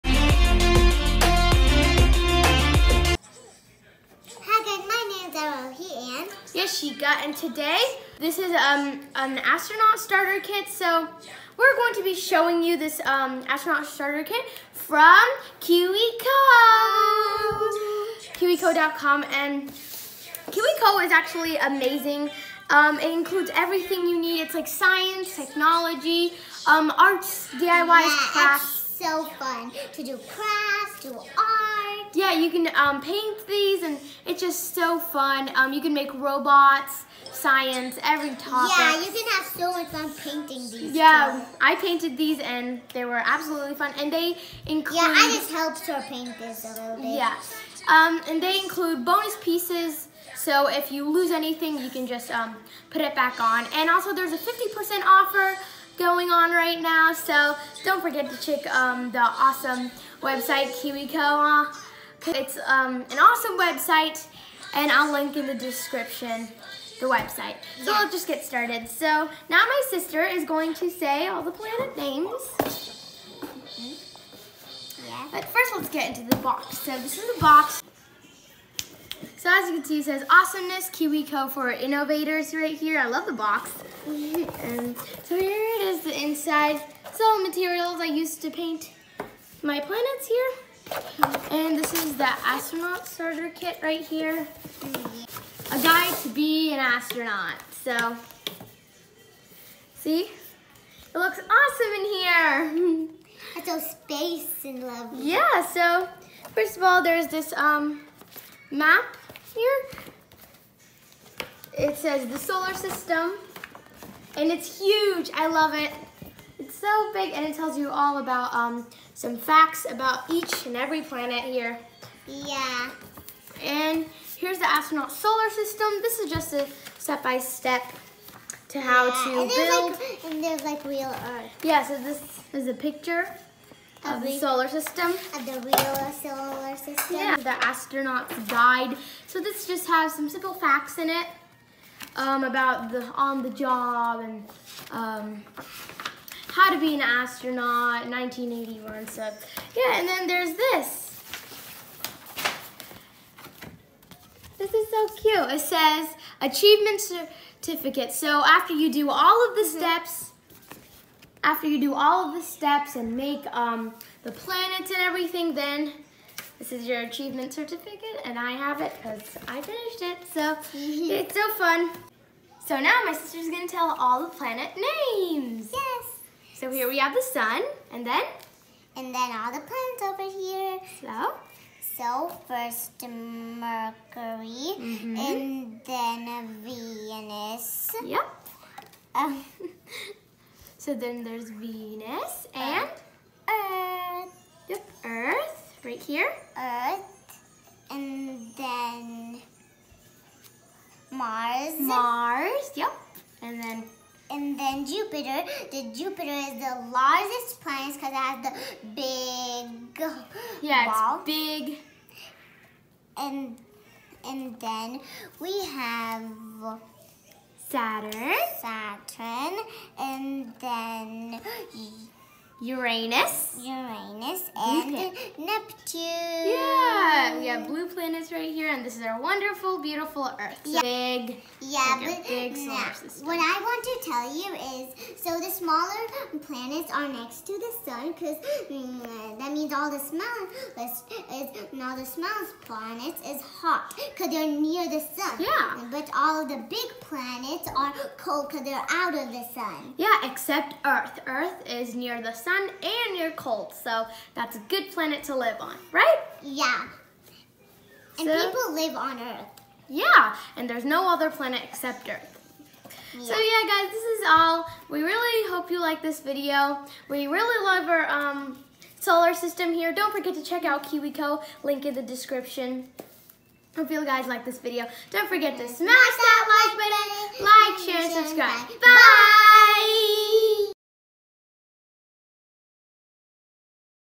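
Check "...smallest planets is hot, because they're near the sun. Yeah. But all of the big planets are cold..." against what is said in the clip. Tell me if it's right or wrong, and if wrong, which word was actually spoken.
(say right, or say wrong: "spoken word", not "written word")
right.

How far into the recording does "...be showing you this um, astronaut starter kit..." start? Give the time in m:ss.
0:12.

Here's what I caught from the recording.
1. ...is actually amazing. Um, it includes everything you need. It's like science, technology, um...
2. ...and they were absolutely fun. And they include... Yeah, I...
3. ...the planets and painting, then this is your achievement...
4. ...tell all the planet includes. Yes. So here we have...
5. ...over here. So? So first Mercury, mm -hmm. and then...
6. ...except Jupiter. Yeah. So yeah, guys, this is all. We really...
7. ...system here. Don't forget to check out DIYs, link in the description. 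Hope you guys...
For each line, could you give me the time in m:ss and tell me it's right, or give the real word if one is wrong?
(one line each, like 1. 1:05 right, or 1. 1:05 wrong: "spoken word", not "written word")
1. 0:21 right
2. 0:42 right
3. 2:44 wrong: "everything", not "painting"
4. 2:53 wrong: "names", not "includes"
5. 3:00 right
6. 4:21 wrong: "Earth", not "Jupiter"
7. 4:29 wrong: "KiwiCo", not "DIYs".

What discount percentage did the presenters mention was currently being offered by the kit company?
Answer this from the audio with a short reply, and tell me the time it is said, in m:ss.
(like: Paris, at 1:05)
50%, at 0:54.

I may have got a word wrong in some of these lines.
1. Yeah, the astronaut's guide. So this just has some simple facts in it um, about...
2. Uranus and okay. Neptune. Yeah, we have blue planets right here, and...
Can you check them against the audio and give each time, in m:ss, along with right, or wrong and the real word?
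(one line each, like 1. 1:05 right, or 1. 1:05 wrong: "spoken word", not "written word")
1. 2:17 right
2. 3:43 right.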